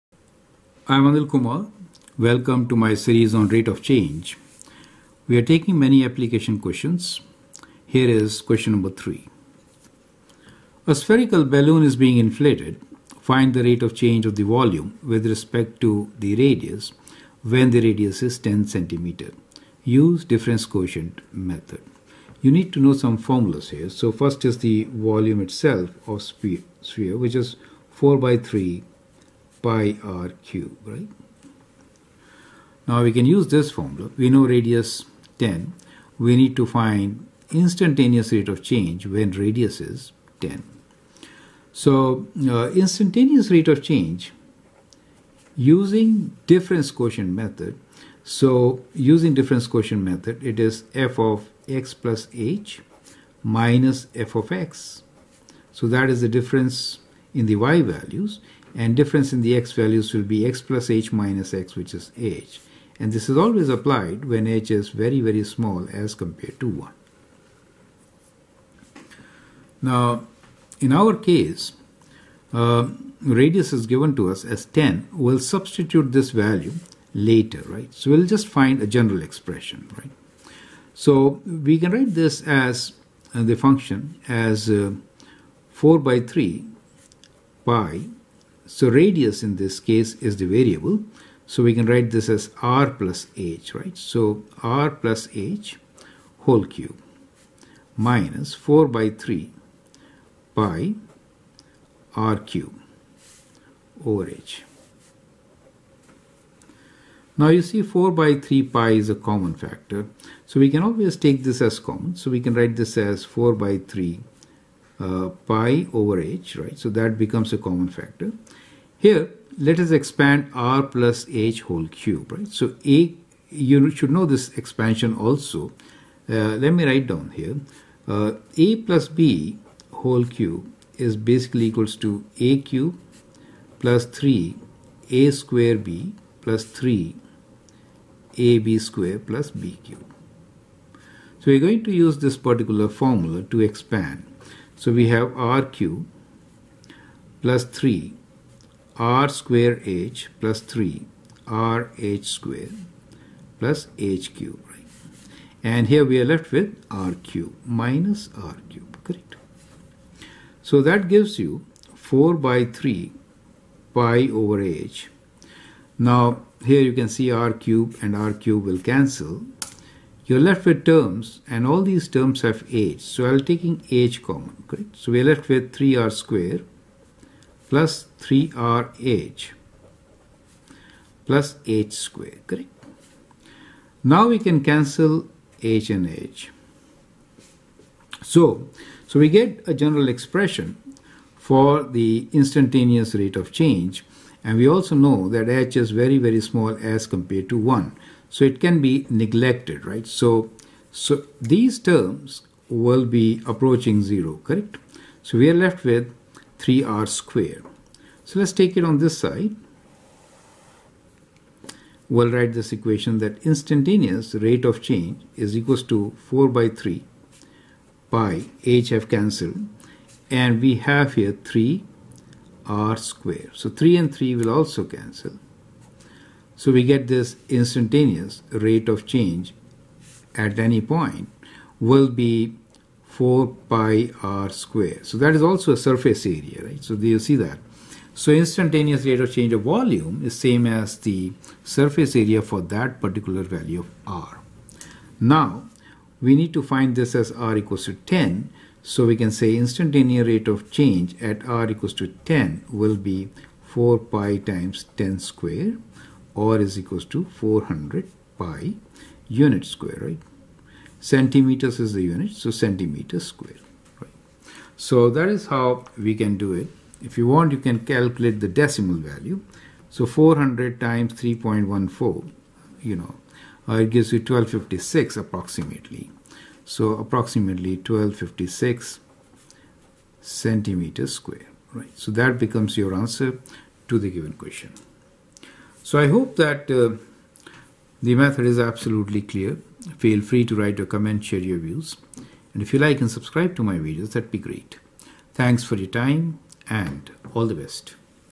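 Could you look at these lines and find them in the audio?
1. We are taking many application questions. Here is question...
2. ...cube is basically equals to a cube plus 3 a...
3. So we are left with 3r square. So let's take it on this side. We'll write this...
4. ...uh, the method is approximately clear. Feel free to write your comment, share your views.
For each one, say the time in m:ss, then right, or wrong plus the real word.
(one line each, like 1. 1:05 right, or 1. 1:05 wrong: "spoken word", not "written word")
1. 0:05 right
2. 2:10 right
3. 3:25 right
4. 4:46 wrong: "absolutely", not "approximately".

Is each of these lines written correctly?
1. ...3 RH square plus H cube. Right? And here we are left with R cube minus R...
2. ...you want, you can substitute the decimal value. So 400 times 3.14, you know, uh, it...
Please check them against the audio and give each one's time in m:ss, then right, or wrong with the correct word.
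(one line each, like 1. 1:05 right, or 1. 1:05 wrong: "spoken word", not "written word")
1. 2:30 right
2. 4:27 wrong: "calculate", not "substitute".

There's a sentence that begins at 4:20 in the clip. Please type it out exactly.
Centimeters is the unit, so centimeter square, right?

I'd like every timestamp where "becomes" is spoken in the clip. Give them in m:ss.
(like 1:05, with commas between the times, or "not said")
1:57, 4:42.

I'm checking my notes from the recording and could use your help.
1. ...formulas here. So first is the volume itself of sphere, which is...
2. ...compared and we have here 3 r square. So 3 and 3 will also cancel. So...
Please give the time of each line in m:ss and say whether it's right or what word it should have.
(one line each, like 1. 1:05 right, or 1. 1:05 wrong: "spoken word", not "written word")
1. 0:23 right
2. 3:39 wrong: "cancelled", not "compared".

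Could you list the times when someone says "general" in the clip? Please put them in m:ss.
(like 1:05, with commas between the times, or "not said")
1:18, 3:09.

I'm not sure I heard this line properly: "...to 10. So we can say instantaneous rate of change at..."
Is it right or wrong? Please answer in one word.
right.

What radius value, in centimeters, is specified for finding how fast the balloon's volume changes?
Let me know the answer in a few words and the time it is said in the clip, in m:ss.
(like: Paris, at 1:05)
10 cm, at 0:18.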